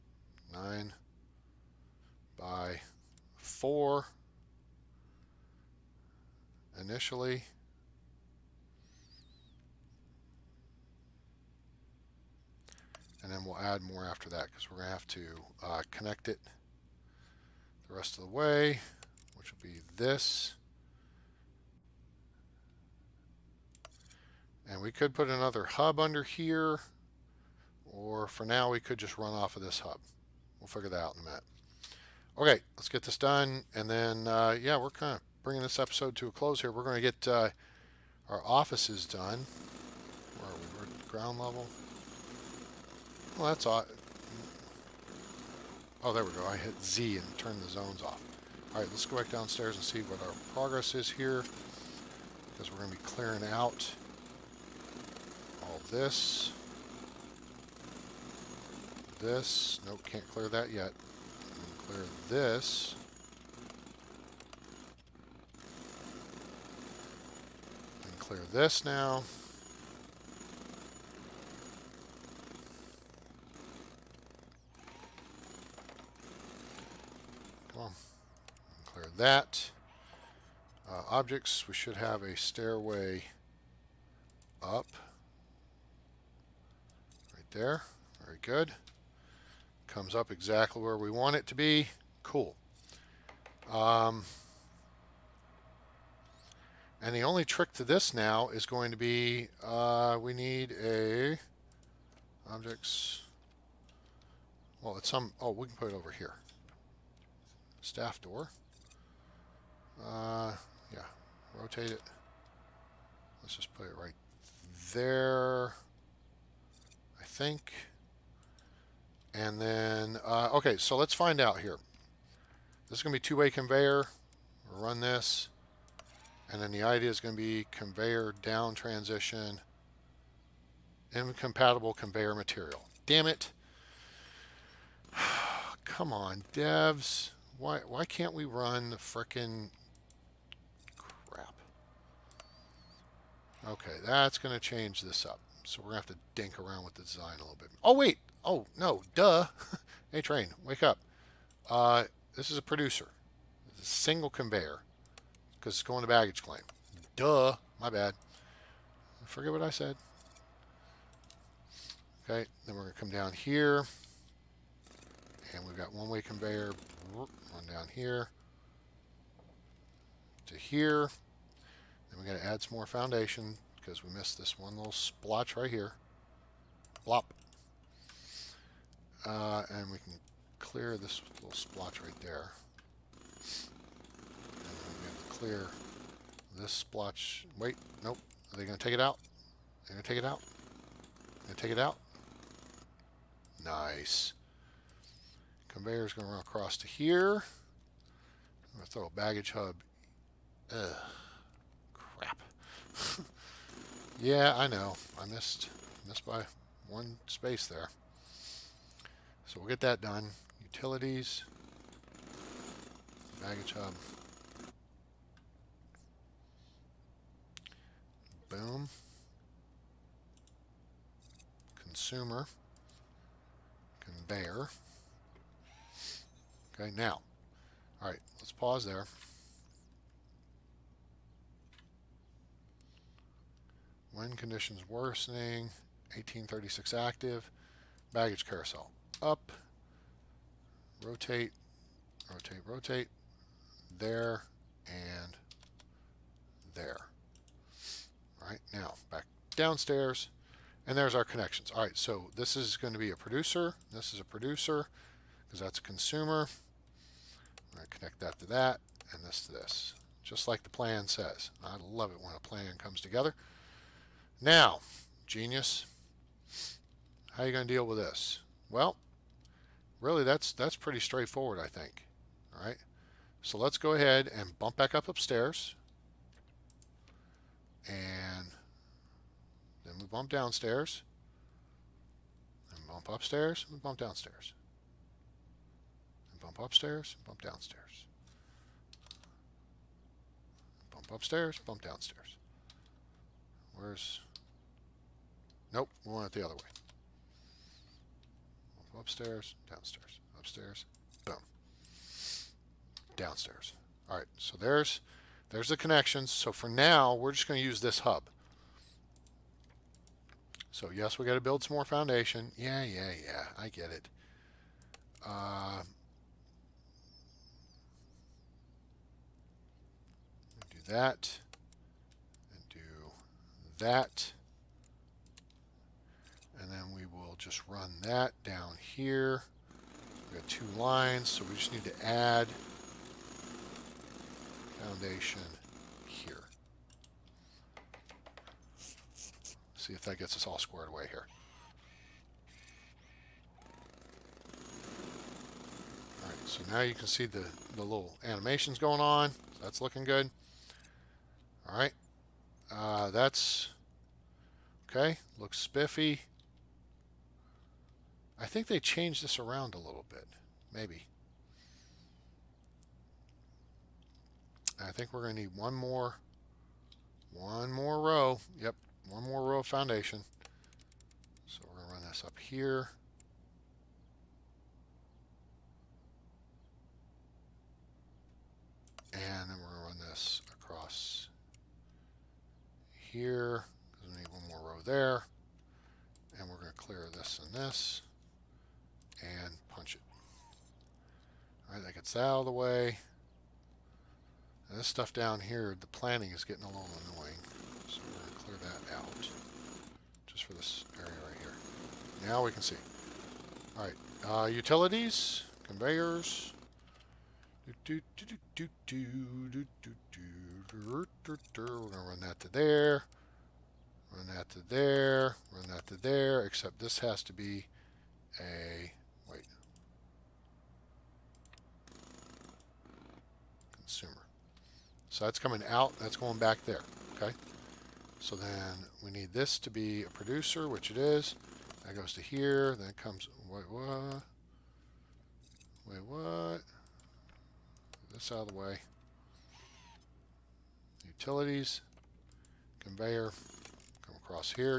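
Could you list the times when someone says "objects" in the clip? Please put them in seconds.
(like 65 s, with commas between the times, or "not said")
81 s, 102 s.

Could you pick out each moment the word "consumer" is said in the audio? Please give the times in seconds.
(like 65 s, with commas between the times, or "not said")
221 s, 255 s.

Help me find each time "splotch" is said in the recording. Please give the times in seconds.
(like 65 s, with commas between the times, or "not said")
174 s, 181 s, 186 s.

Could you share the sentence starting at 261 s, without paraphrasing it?
I love it when a plan comes together.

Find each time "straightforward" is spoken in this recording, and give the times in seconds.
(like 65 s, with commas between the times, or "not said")
270 s.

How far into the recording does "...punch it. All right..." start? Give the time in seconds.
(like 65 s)
389 s.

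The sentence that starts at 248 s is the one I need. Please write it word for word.
All right, now back downstairs, and there's our connections.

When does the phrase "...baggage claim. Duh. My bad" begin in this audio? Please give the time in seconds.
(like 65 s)
156 s.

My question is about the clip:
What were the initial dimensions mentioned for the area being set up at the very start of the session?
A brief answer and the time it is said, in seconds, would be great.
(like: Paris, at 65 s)
9 by 4, at 0 s.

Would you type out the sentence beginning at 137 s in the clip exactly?
Why, why can't we run the frickin' crap?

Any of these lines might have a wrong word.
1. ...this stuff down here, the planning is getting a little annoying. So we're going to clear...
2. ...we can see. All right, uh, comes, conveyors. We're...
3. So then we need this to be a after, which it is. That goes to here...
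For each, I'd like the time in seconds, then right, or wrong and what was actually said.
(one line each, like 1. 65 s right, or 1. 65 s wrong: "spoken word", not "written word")
1. 394 s right
2. 402 s wrong: "utilities", not "comes"
3. 428 s wrong: "producer", not "after".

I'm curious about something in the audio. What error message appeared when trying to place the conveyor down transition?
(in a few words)
Incompatible conveyor material.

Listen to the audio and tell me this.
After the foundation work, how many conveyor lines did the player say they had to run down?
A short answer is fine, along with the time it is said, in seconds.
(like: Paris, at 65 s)
2, at 330 s.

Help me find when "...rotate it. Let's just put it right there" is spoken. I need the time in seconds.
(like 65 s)
111 s.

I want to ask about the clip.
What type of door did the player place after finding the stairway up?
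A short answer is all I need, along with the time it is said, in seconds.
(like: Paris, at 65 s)
Staff door, at 107 s.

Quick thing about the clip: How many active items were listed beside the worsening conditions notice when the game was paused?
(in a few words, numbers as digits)
1836.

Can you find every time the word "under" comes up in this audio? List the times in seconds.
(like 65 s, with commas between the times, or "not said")
25 s.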